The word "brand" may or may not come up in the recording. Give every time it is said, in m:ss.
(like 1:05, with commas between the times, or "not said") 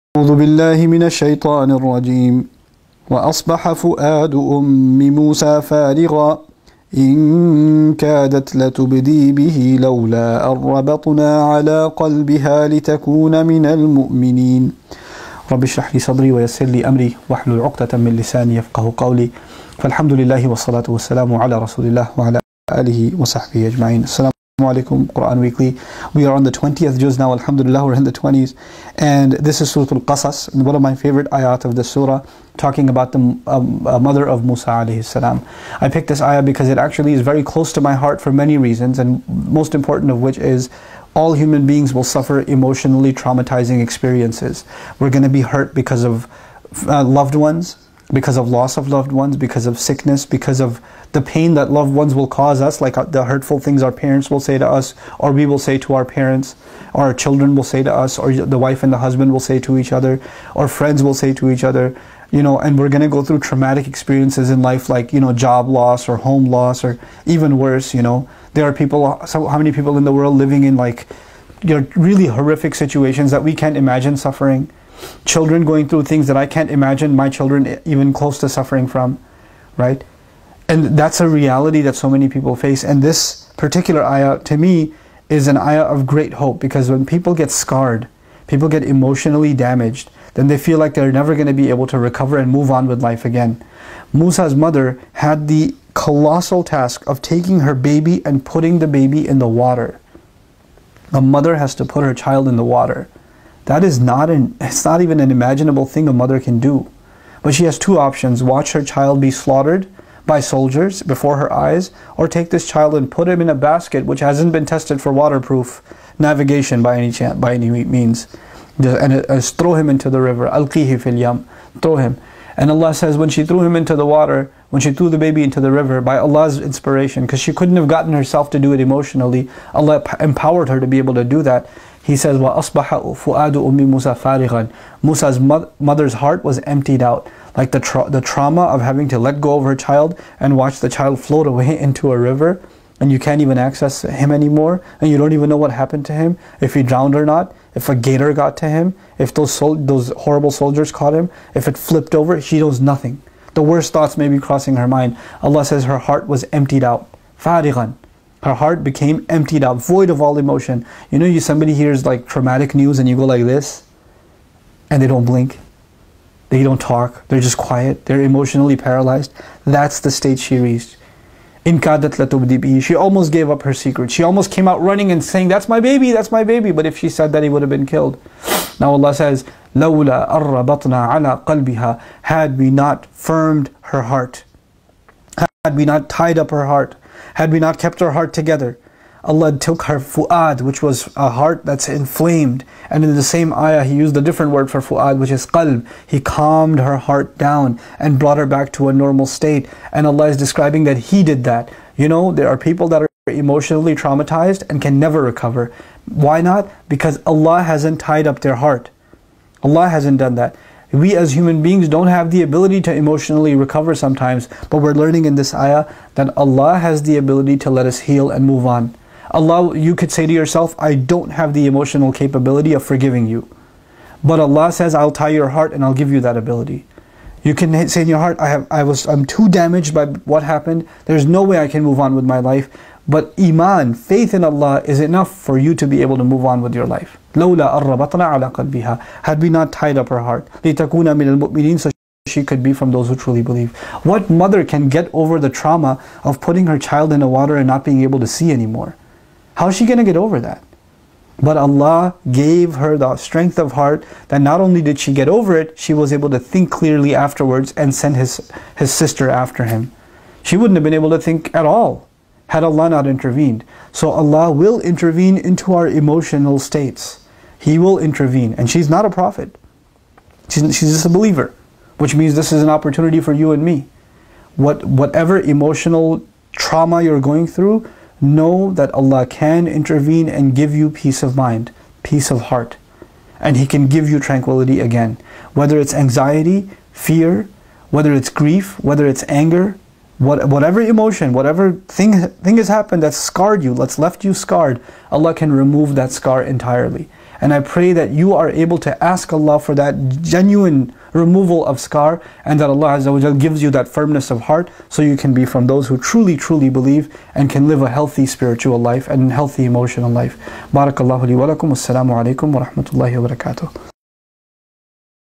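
not said.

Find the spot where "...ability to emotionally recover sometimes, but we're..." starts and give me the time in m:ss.
3:32.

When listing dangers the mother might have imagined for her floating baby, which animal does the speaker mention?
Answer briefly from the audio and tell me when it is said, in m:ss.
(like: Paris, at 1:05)
gator, at 2:27.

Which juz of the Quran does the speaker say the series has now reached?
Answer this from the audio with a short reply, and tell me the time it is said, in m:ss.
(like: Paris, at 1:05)
20th, at 0:26.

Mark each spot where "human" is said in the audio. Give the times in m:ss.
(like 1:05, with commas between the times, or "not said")
0:41, 3:31.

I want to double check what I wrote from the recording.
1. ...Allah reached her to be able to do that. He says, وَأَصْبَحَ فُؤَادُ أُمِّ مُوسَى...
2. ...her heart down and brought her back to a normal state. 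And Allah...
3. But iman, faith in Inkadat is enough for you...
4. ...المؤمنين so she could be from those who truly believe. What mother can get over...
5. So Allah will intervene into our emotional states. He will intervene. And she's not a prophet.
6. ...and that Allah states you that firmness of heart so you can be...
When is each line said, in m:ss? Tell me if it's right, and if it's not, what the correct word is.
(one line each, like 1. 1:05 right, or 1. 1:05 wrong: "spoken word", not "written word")
1. 2:09 wrong: "empowered", not "reached"
2. 3:16 right
3. 3:53 wrong: "Allah", not "Inkadat"
4. 4:01 right
5. 4:23 right
6. 5:02 wrong: "gives", not "states".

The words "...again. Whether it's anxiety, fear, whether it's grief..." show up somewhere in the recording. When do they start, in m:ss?
4:44.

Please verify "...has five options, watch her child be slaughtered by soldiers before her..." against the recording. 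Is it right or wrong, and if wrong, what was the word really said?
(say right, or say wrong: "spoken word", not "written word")
wrong: "two", not "five".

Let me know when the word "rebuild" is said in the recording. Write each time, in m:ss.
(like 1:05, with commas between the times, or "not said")
not said.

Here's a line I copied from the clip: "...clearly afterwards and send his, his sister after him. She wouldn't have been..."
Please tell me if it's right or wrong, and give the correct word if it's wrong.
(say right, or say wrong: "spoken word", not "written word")
right.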